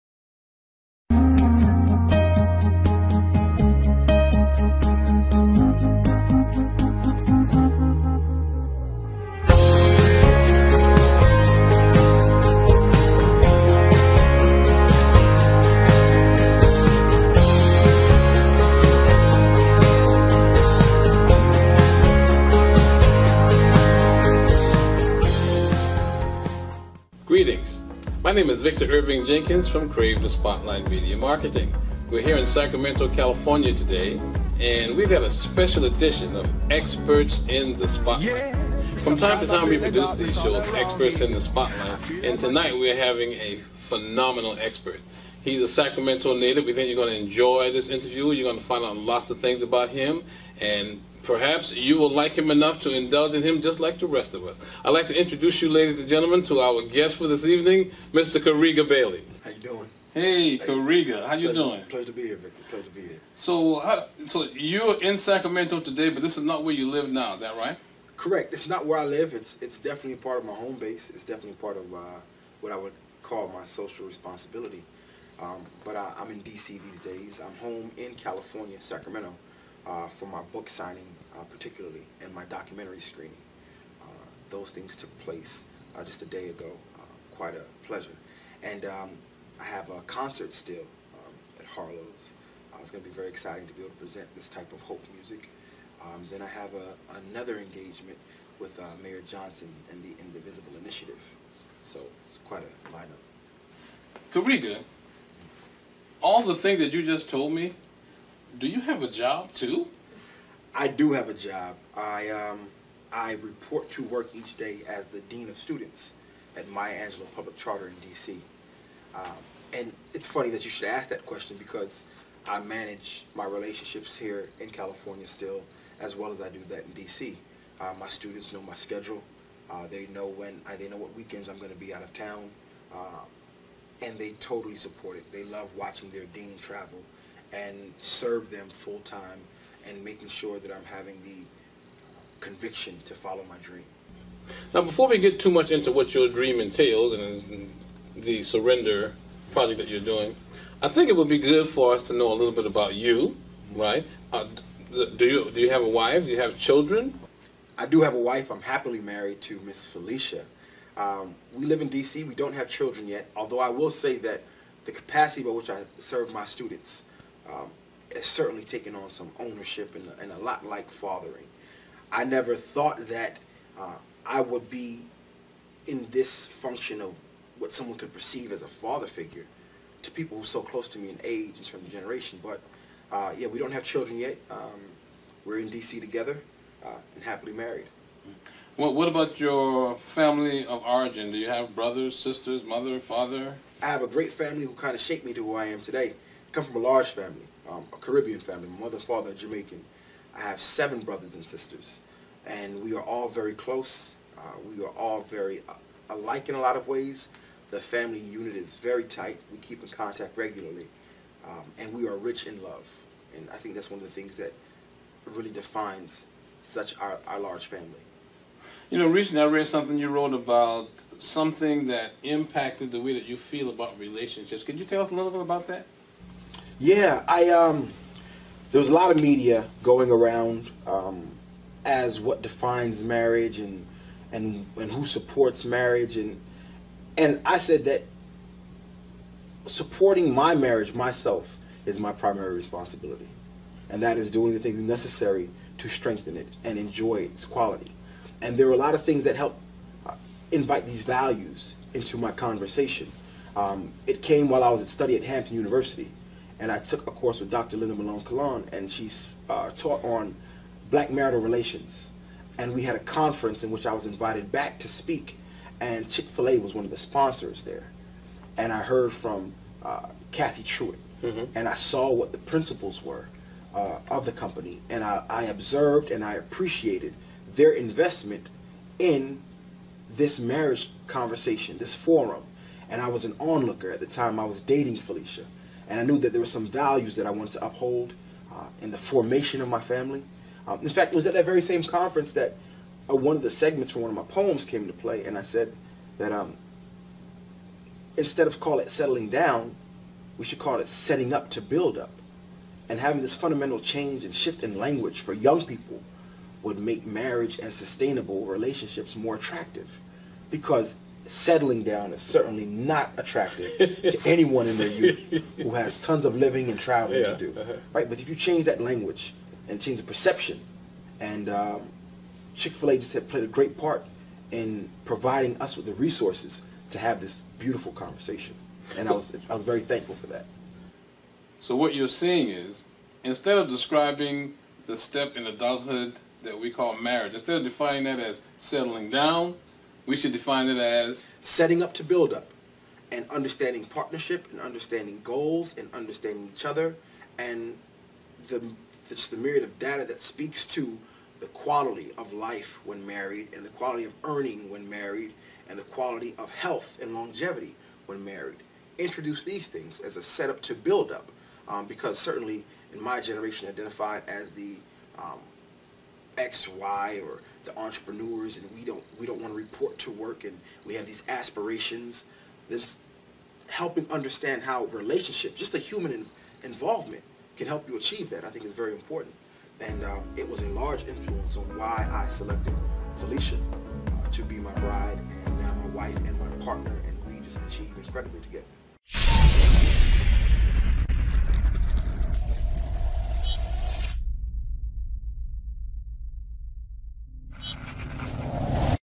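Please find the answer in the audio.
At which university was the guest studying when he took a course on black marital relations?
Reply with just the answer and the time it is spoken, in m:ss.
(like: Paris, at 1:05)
Hampton University, at 4:15.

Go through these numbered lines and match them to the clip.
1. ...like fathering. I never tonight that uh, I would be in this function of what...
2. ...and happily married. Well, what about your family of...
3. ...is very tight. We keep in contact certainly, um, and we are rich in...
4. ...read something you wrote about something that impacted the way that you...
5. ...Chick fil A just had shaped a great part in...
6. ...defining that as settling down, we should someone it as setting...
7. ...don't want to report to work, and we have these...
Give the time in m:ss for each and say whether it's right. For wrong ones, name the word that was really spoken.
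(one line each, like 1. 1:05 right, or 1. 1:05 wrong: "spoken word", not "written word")
1. 2:50 wrong: "thought", not "tonight"
2. 3:07 right
3. 3:28 wrong: "regularly", not "certainly"
4. 3:39 right
5. 5:22 wrong: "played", not "shaped"
6. 5:37 wrong: "define", not "someone"
7. 6:09 right.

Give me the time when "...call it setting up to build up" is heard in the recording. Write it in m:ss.
5:00.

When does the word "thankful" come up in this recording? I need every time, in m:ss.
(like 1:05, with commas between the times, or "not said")
5:29.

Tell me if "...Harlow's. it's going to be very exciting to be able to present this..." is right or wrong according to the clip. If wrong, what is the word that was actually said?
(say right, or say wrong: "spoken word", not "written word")
right.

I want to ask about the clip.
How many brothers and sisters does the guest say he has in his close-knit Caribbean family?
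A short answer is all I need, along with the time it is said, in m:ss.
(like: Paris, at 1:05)
7, at 3:20.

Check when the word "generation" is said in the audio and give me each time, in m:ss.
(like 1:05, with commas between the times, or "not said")
3:01, 6:03.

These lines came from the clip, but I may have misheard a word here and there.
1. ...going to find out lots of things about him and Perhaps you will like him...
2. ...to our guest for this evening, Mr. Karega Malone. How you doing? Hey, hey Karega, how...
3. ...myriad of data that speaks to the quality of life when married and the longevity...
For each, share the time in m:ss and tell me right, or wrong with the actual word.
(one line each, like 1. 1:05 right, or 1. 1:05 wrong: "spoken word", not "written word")
1. 0:48 right
2. 0:56 wrong: "Bailey", not "Malone"
3. 5:49 wrong: "quality", not "longevity".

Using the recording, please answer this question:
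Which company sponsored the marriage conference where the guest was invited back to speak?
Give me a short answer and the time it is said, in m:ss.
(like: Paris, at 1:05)
Chick-fil-A, at 4:26.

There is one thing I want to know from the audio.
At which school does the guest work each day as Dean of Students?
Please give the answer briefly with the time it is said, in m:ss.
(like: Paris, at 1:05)
Maya Angelou Public Charter, at 1:56.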